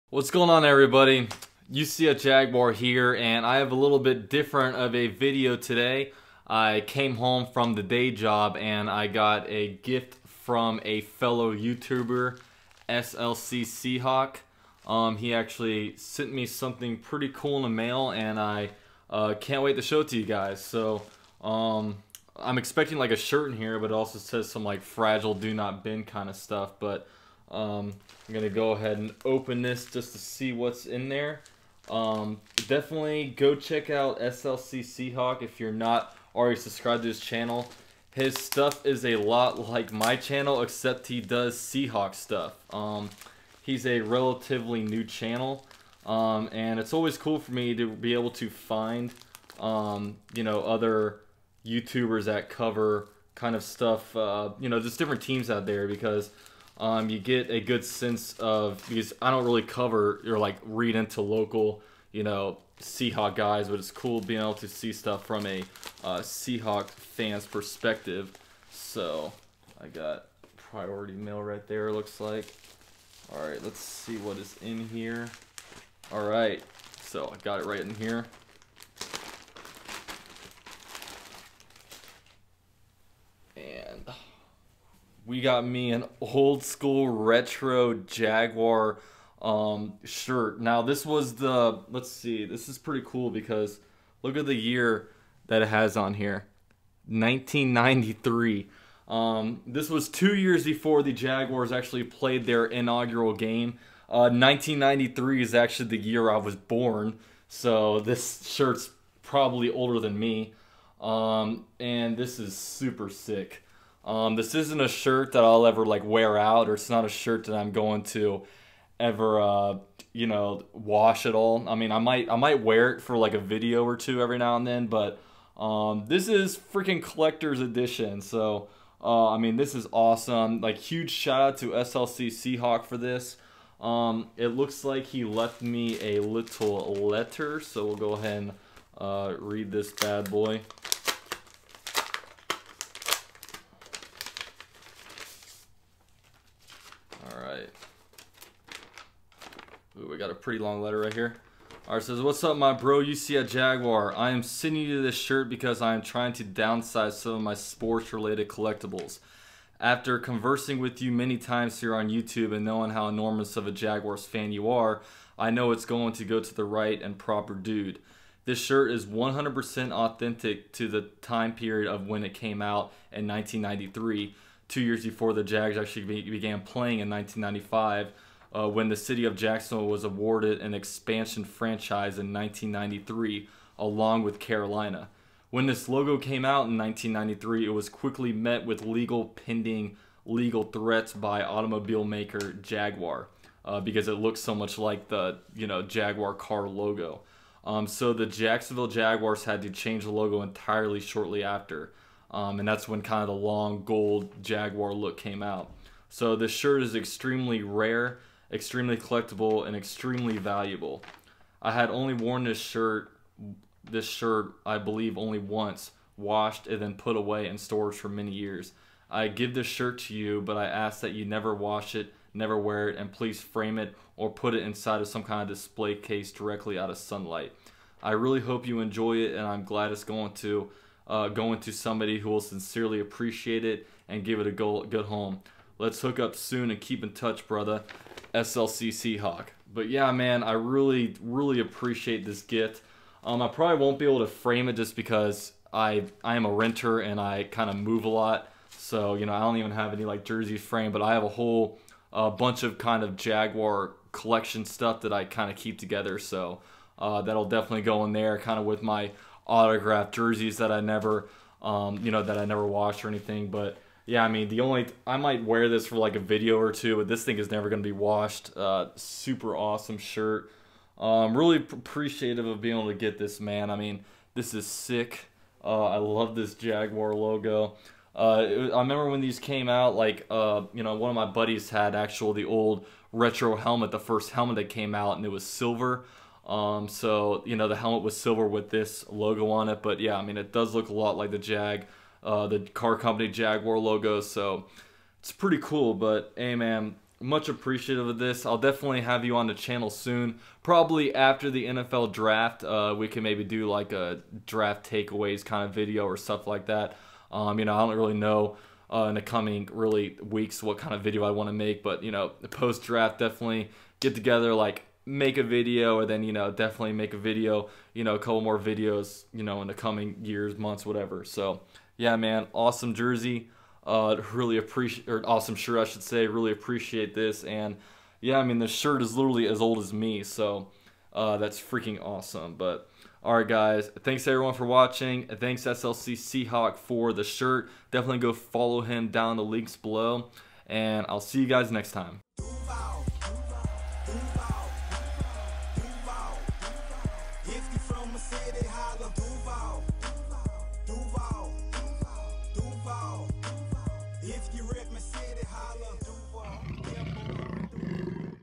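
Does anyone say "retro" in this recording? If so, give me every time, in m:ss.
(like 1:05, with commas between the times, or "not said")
1:27, 4:43.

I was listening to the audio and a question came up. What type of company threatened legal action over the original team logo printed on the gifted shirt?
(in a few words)
Automobile maker.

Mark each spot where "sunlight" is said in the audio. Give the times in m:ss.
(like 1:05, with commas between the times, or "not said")
3:46.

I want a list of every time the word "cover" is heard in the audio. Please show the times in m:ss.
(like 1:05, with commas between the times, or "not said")
0:52, 0:59.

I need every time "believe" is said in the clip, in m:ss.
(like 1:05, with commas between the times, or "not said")
3:34.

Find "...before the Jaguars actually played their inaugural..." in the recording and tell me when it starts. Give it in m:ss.
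1:40.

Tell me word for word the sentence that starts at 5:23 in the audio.
Uh, really appreciate, or awesome shirt, I should say.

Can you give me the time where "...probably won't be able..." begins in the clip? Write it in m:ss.
4:03.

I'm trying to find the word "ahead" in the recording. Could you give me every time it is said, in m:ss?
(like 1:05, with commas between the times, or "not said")
0:28, 2:18.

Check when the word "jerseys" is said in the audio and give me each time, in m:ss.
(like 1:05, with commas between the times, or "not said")
4:10, 4:20, 5:22.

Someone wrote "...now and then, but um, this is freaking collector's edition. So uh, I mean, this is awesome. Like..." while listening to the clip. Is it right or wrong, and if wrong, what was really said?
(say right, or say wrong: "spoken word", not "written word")
right.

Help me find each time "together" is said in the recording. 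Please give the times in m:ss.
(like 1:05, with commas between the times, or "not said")
4:15, 5:14.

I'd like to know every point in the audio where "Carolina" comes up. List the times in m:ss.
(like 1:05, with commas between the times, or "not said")
3:04.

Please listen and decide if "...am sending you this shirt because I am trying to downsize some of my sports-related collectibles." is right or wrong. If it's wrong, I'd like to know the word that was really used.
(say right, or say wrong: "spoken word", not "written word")
right.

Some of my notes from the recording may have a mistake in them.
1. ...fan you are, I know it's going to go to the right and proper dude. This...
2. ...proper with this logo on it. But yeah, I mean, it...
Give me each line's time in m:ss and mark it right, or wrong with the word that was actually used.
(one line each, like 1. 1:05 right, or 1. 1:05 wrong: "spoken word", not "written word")
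1. 2:44 right
2. 4:48 wrong: "silver", not "proper".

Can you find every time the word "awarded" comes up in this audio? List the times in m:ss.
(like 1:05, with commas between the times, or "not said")
3:00.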